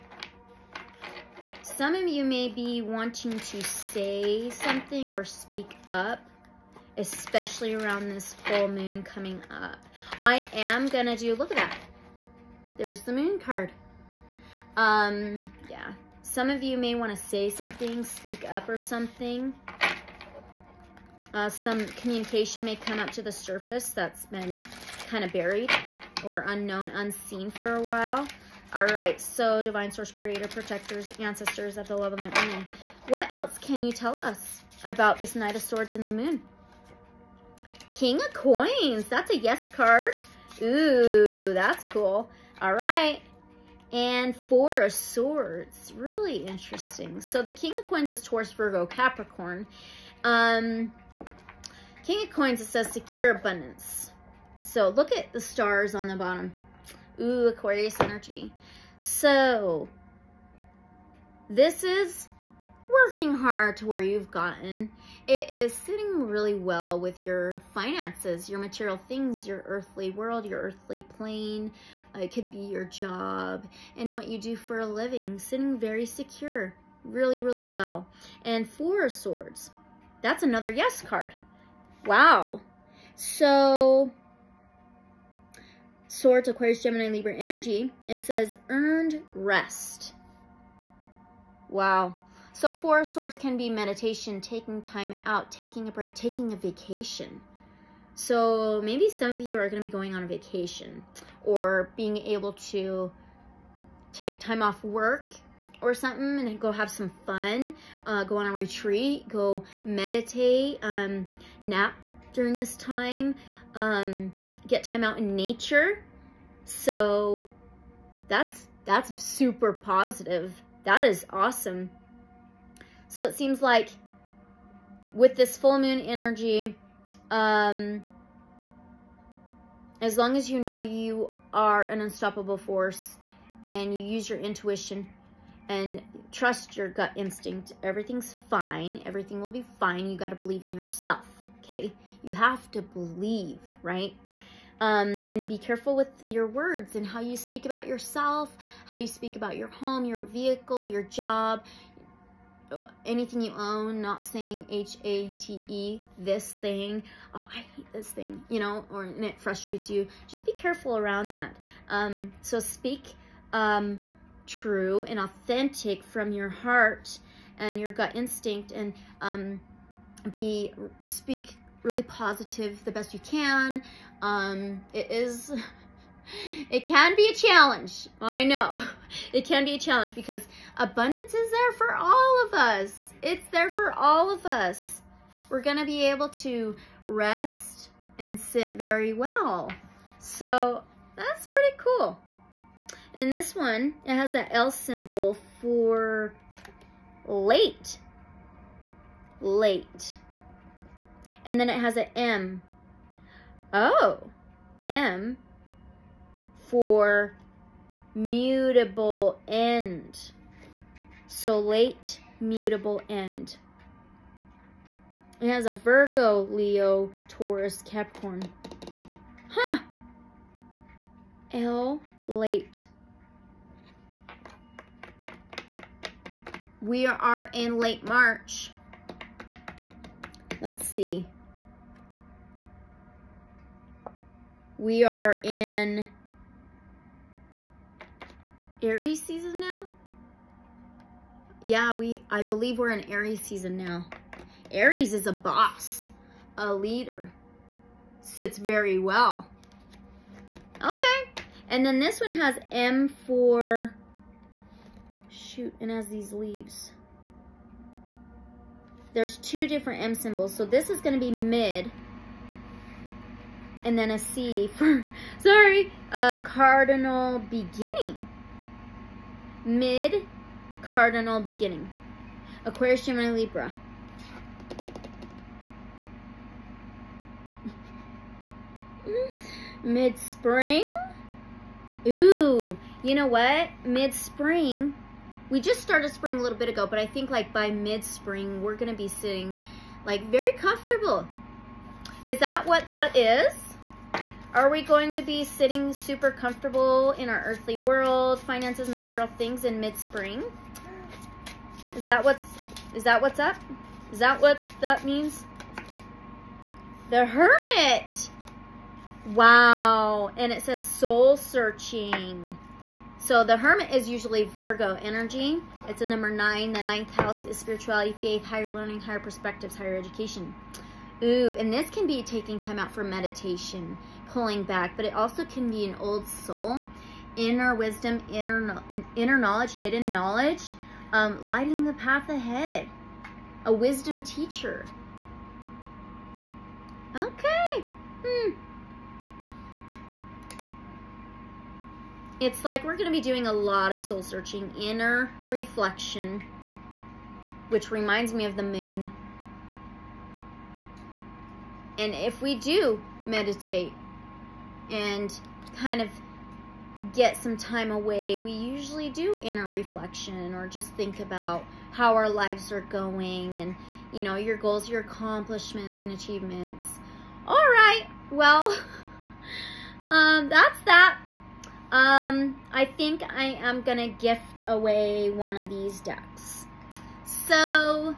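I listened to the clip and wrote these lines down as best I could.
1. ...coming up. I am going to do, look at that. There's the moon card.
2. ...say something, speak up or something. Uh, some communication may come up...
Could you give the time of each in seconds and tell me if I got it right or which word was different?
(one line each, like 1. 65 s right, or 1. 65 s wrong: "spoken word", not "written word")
1. 9 s right
2. 17 s right.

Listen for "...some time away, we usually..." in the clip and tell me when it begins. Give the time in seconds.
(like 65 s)
357 s.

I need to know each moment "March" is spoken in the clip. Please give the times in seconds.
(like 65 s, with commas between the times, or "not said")
228 s.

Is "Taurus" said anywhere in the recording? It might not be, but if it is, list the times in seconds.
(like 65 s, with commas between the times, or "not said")
48 s, 217 s.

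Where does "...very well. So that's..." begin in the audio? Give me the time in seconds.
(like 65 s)
188 s.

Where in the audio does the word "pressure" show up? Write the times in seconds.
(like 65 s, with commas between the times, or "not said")
not said.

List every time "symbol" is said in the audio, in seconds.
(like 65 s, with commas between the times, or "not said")
194 s, 260 s.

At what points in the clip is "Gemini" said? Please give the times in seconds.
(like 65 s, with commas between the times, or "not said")
86 s, 273 s.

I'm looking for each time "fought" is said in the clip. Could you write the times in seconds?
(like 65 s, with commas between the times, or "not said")
not said.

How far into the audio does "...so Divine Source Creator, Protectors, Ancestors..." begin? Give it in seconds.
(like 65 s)
29 s.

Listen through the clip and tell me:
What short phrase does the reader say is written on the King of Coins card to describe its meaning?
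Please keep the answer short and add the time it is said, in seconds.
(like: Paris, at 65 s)
Secure abundance, at 52 s.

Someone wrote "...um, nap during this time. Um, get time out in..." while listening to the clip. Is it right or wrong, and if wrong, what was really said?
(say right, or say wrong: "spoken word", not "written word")
right.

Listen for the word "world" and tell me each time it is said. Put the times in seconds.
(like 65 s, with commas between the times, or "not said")
70 s, 297 s.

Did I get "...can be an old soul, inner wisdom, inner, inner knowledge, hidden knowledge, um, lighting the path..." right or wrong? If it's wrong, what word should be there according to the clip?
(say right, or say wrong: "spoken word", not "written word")
right.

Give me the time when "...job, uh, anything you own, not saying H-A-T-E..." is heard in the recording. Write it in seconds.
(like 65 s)
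151 s.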